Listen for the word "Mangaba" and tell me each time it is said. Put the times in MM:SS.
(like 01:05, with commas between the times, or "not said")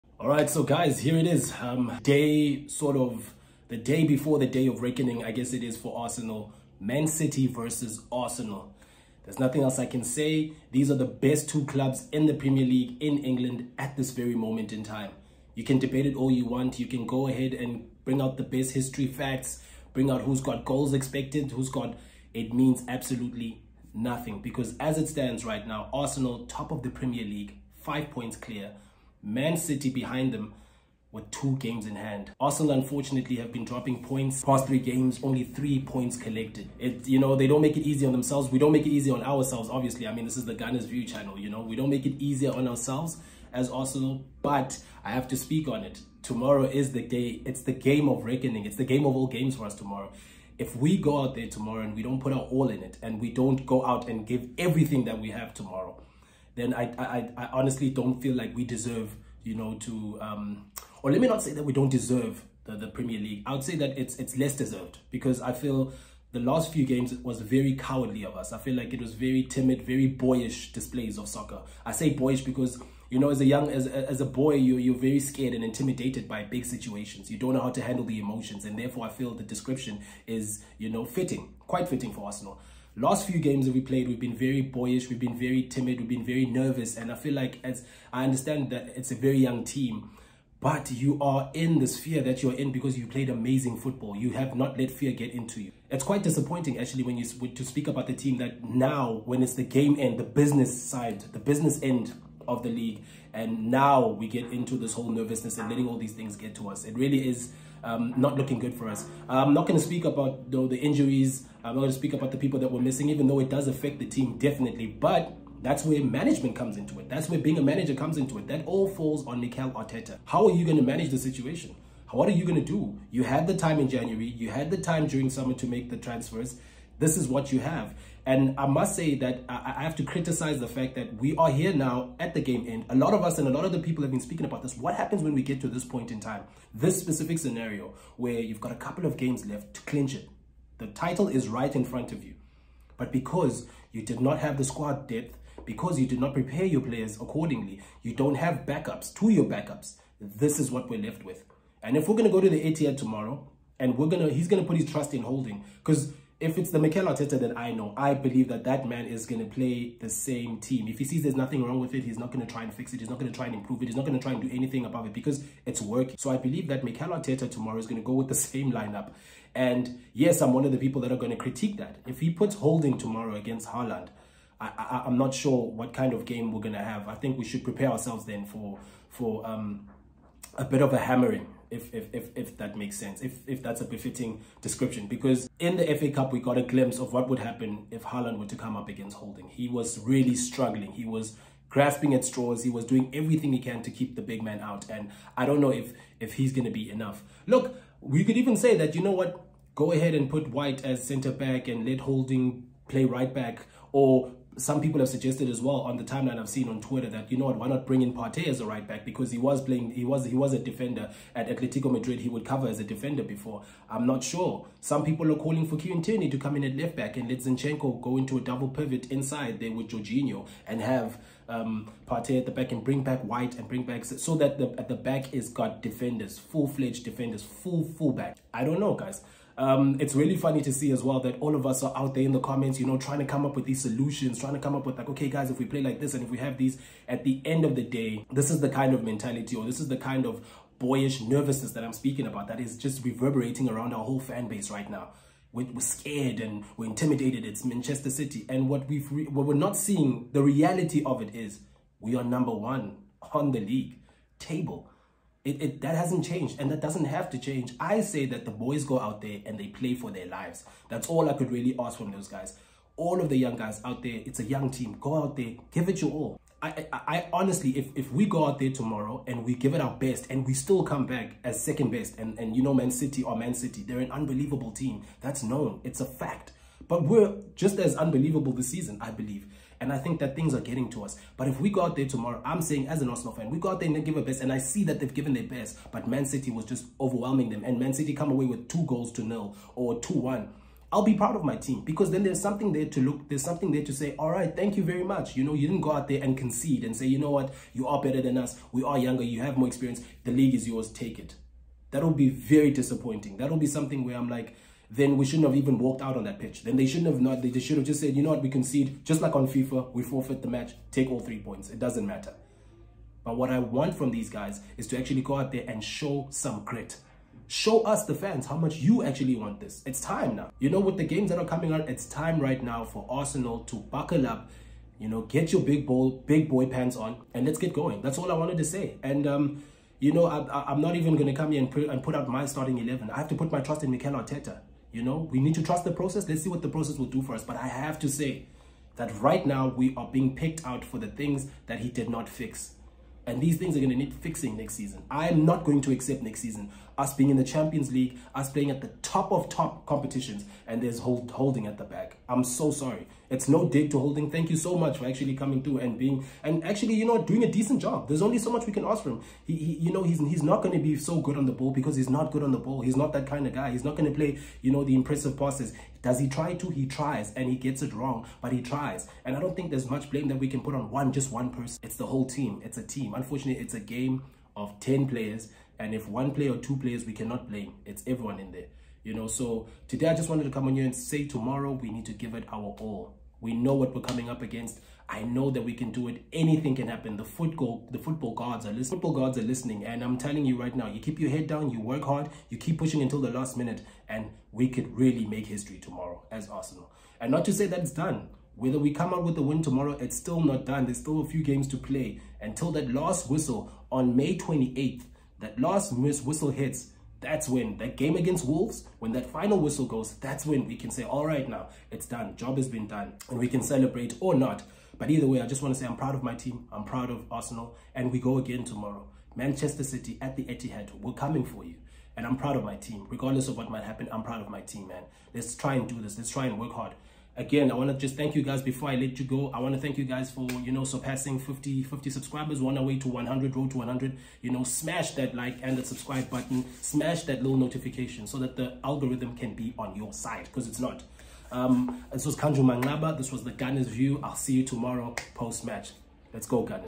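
07:22.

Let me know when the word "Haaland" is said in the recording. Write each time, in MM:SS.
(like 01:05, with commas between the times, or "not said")
02:53, 03:08.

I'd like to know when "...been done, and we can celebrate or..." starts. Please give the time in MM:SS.
06:52.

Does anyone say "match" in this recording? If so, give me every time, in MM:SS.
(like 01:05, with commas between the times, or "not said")
05:10, 07:25.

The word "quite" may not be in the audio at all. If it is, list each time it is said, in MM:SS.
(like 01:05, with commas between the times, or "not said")
01:21, 01:36.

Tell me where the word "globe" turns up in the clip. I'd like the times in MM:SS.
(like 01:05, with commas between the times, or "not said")
not said.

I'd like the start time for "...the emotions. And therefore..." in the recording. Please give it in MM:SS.
01:18.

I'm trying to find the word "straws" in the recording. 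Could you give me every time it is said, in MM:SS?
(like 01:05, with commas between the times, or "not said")
03:12.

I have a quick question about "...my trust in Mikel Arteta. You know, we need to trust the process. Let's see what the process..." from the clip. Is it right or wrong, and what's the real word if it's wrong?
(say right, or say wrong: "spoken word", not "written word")
right.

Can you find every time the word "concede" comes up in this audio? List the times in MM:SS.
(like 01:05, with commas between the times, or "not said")
04:56, 05:08.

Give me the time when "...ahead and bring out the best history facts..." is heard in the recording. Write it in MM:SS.
00:17.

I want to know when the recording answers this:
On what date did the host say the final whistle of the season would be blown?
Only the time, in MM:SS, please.
06:44.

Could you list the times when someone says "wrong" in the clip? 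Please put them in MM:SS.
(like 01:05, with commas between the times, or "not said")
02:41, 06:07.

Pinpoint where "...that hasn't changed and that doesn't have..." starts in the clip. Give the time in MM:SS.
04:15.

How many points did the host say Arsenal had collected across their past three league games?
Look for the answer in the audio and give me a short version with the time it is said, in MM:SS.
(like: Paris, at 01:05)
3, at 00:35.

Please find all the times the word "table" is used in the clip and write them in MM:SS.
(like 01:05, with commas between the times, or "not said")
04:14.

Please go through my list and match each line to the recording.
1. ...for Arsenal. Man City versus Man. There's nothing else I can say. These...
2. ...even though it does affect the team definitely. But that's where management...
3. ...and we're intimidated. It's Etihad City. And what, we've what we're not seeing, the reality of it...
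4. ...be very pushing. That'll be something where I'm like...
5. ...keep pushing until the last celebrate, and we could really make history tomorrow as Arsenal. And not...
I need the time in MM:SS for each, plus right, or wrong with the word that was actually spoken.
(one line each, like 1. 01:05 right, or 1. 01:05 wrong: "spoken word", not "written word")
1. 00:05 wrong: "Arsenal", not "Man"
2. 01:53 right
3. 04:06 wrong: "Manchester", not "Etihad"
4. 05:02 wrong: "disappointing", not "pushing"
5. 06:32 wrong: "minute", not "celebrate".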